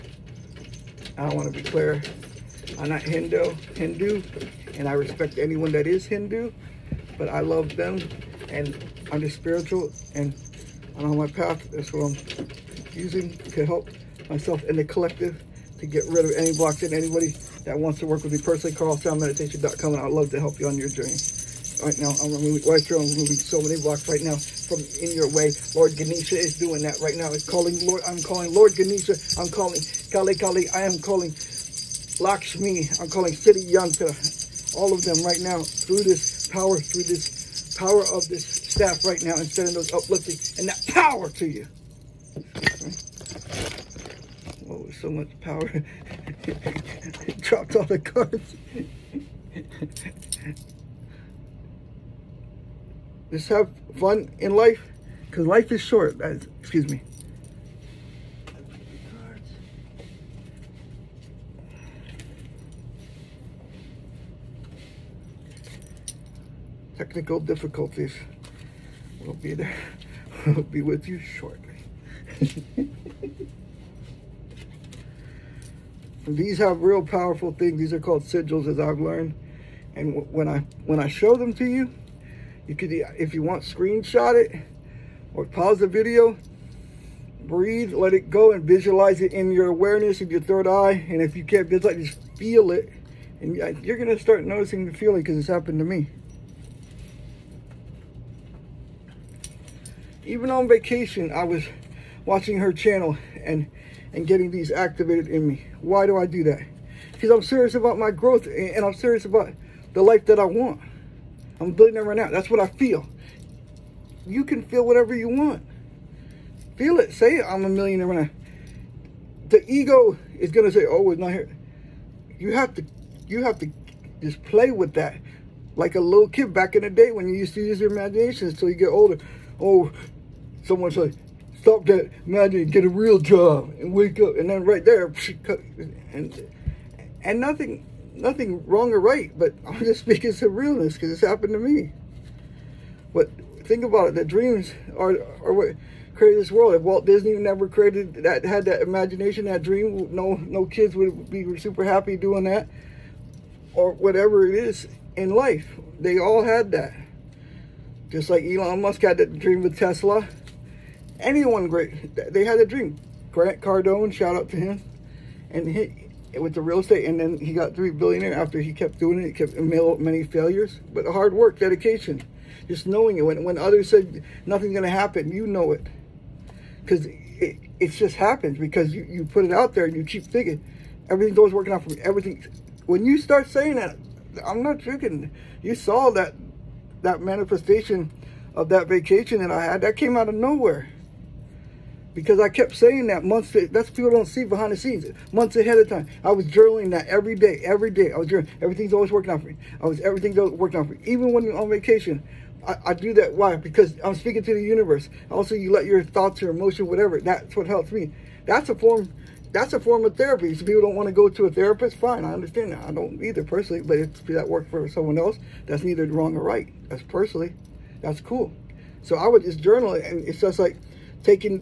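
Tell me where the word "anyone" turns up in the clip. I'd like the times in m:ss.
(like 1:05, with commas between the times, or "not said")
0:05, 2:41.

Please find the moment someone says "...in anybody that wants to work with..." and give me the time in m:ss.
0:16.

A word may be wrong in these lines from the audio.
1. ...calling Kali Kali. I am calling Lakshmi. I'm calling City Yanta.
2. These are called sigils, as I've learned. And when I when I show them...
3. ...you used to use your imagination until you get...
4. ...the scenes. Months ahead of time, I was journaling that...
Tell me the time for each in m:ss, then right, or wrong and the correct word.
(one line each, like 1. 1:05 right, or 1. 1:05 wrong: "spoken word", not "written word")
1. 0:29 right
2. 1:17 right
3. 2:07 right
4. 3:14 right.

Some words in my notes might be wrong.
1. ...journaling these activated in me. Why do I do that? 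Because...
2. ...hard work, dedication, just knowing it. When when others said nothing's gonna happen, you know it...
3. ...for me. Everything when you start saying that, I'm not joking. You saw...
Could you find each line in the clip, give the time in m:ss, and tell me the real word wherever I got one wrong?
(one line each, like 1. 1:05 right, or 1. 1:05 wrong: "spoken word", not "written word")
1. 1:44 wrong: "getting", not "journaling"
2. 2:51 right
3. 3:01 right.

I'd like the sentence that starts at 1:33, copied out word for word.
And you're going to start noticing the feeling because it's happened to me.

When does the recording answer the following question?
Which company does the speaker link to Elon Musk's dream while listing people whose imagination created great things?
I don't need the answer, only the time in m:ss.
2:39.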